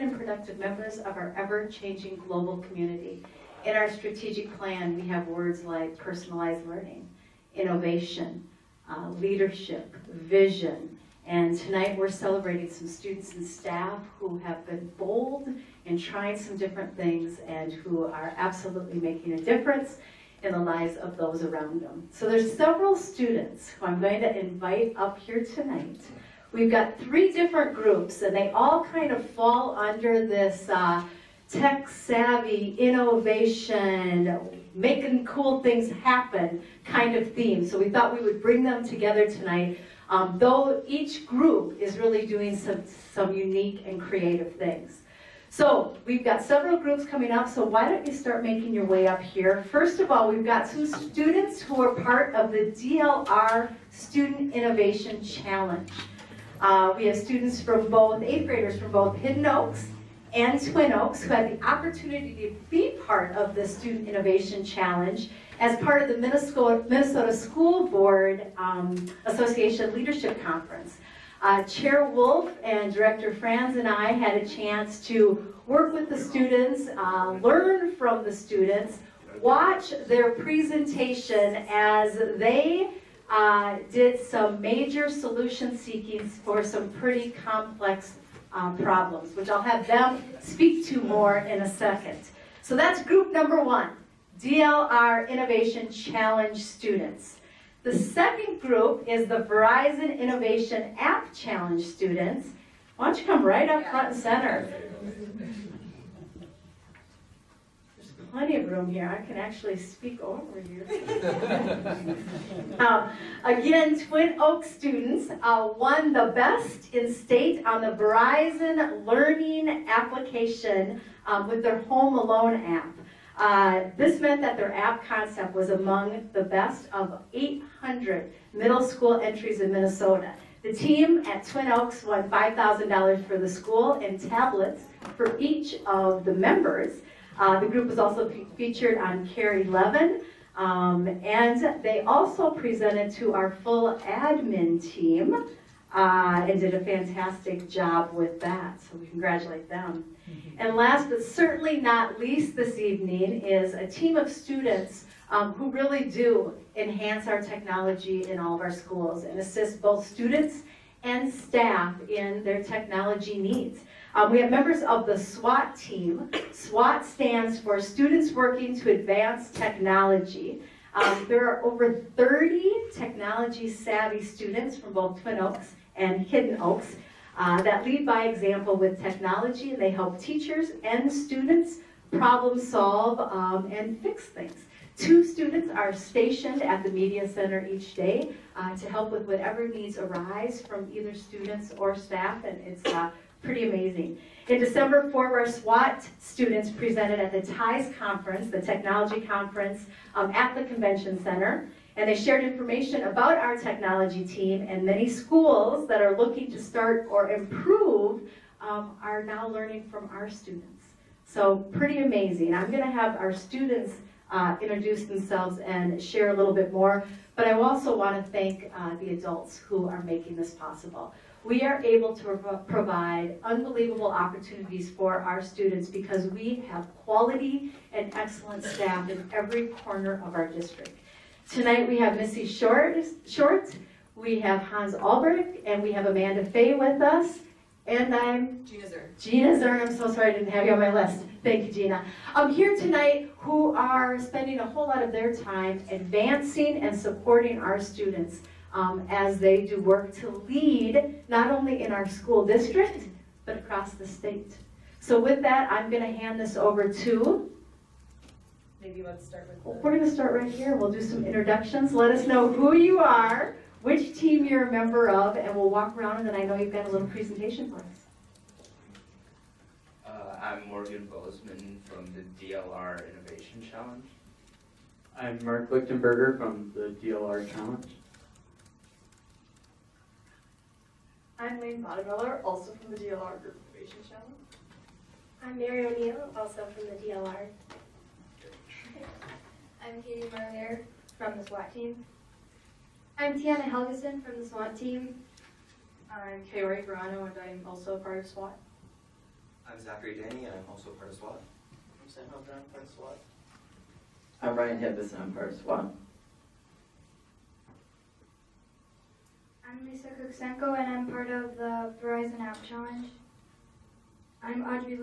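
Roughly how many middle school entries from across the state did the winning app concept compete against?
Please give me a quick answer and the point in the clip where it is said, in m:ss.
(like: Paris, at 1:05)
800, at 2:07.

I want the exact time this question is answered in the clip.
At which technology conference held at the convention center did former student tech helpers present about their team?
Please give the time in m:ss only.
3:17.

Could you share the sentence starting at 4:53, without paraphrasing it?
I'm Tiana Helgeson from the SWAT team.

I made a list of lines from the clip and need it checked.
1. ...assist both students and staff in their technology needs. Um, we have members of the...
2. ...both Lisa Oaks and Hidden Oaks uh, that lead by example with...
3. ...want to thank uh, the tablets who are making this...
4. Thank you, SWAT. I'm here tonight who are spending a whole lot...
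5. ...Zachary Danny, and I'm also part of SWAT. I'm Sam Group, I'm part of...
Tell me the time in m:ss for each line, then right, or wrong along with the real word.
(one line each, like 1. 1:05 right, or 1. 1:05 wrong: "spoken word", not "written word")
1. 2:39 right
2. 2:54 wrong: "Twin", not "Lisa"
3. 3:37 wrong: "adults", not "tablets"
4. 4:01 wrong: "Gina", not "SWAT"
5. 4:59 wrong: "Hunter", not "Group".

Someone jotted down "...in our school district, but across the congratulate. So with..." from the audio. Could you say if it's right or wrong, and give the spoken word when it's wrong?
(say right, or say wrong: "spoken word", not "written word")
wrong: "state", not "congratulate".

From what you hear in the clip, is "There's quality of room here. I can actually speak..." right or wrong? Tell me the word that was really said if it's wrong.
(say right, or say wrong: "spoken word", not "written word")
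wrong: "plenty", not "quality".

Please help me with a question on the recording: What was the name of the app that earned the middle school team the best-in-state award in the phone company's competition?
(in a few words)
Home Alone.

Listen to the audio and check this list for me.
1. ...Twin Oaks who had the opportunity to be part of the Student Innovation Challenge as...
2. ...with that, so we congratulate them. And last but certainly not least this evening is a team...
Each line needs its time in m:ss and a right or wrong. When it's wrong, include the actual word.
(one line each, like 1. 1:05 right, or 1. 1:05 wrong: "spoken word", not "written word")
1. 1:00 right
2. 2:28 right.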